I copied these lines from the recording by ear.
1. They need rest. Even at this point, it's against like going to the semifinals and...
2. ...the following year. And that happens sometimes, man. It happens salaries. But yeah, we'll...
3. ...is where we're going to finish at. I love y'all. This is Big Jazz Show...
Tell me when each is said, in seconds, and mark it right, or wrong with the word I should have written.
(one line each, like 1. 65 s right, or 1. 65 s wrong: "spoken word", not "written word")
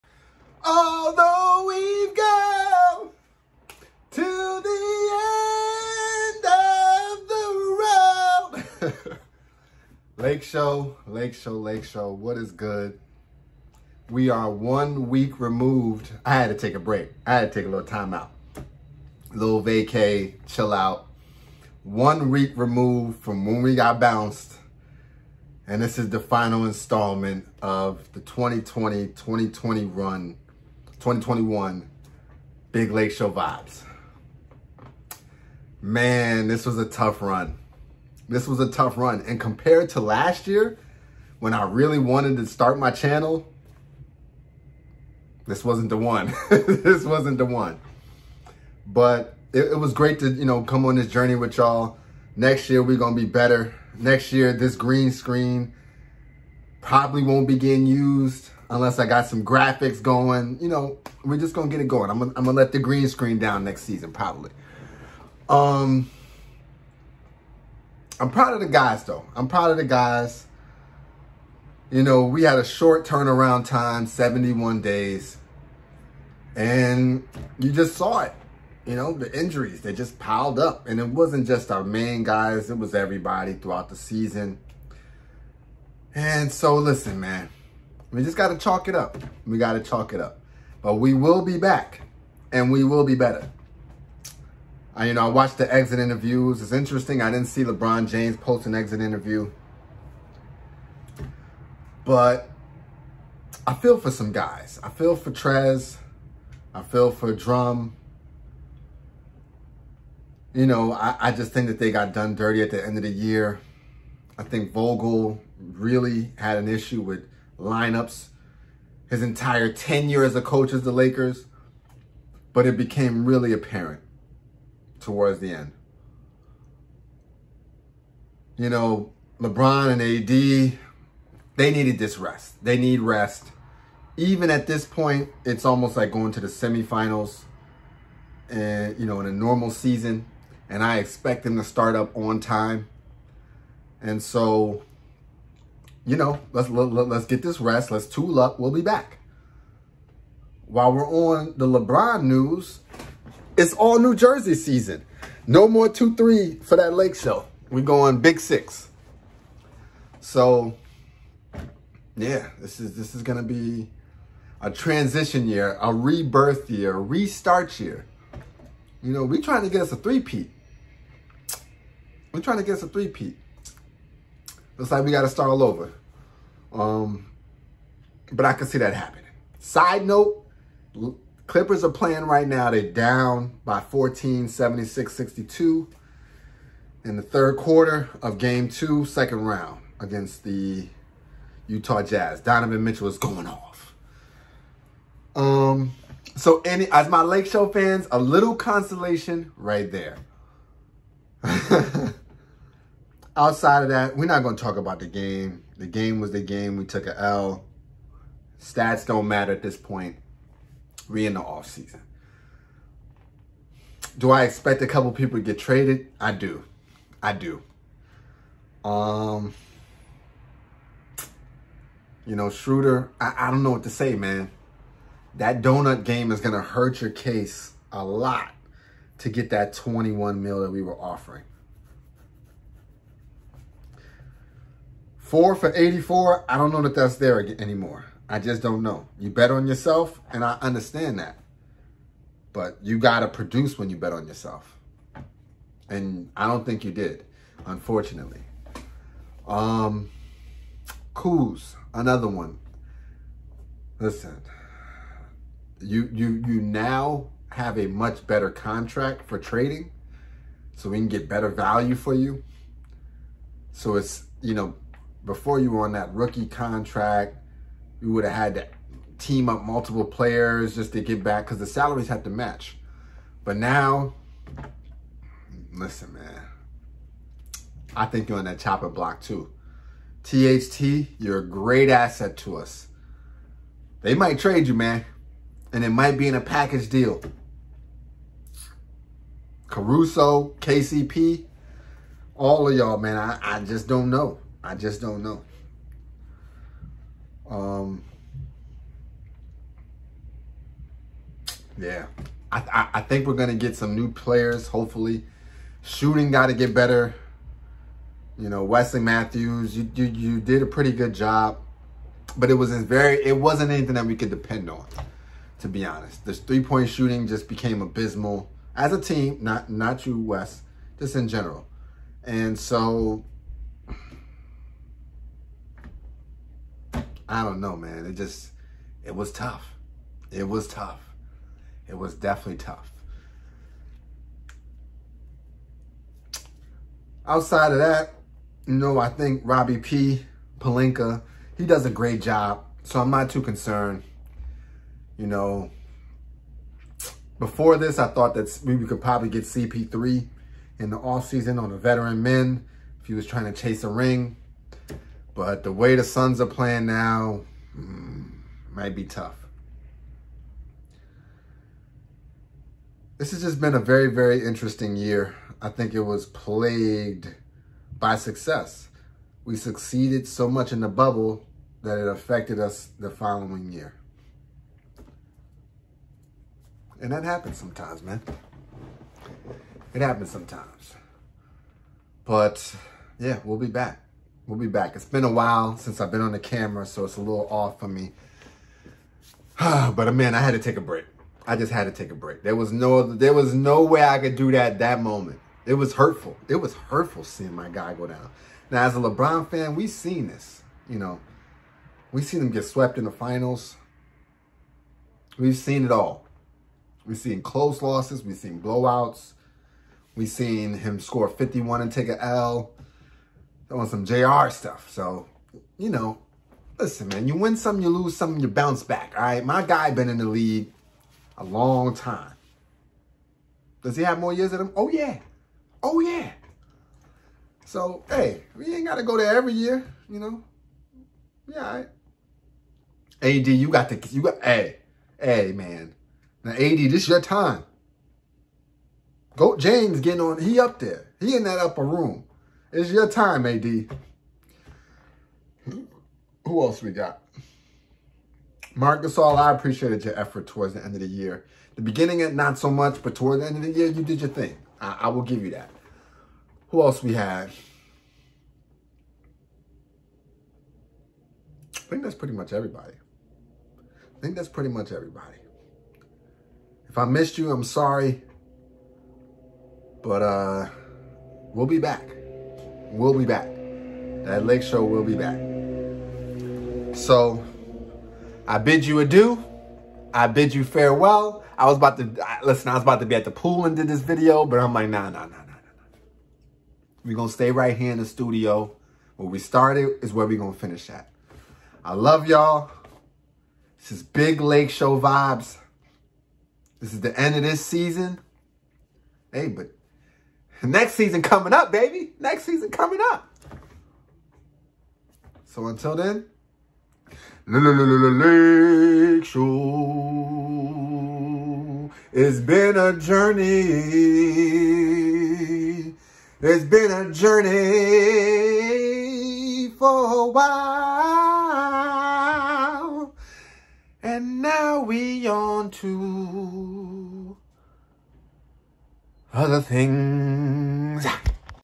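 1. 132 s wrong: "almost", not "against"
2. 372 s wrong: "sometimes", not "salaries"
3. 490 s wrong: "Lake", not "Jazz".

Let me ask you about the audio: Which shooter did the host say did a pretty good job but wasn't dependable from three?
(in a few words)
Wesley Matthews.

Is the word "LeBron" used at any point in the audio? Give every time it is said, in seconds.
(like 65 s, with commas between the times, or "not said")
97 s, 129 s, 151 s, 398 s.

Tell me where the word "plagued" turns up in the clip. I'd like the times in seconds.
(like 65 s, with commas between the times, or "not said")
366 s.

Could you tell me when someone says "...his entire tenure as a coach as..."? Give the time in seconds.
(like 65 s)
119 s.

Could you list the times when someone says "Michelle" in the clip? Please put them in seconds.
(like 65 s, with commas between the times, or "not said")
not said.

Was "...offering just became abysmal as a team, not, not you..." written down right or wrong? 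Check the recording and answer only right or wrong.
wrong.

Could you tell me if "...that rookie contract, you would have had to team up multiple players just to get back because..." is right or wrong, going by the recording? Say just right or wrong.
right.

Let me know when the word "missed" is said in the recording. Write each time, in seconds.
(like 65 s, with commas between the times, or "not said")
467 s.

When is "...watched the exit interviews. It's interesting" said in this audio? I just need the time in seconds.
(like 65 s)
95 s.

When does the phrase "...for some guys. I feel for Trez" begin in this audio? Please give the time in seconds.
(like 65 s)
103 s.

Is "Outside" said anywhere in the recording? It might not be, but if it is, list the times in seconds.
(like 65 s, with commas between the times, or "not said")
203 s, 337 s.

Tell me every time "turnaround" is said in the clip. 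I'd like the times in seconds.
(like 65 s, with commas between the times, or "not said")
73 s.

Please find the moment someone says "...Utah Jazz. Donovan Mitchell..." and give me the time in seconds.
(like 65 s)
191 s.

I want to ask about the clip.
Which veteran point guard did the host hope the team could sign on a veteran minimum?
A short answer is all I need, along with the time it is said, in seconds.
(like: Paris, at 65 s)
CP3, at 349 s.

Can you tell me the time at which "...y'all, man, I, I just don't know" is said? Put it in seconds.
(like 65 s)
292 s.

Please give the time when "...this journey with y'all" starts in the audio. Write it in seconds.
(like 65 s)
50 s.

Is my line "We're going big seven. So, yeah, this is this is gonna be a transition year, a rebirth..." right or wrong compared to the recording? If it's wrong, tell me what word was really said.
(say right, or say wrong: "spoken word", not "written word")
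wrong: "six", not "seven".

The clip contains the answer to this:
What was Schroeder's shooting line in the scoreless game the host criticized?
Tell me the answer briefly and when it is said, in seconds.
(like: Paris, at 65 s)
0 for 8, at 235 s.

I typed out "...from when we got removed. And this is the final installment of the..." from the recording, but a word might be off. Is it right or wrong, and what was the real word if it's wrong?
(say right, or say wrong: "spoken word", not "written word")
wrong: "bounced", not "removed".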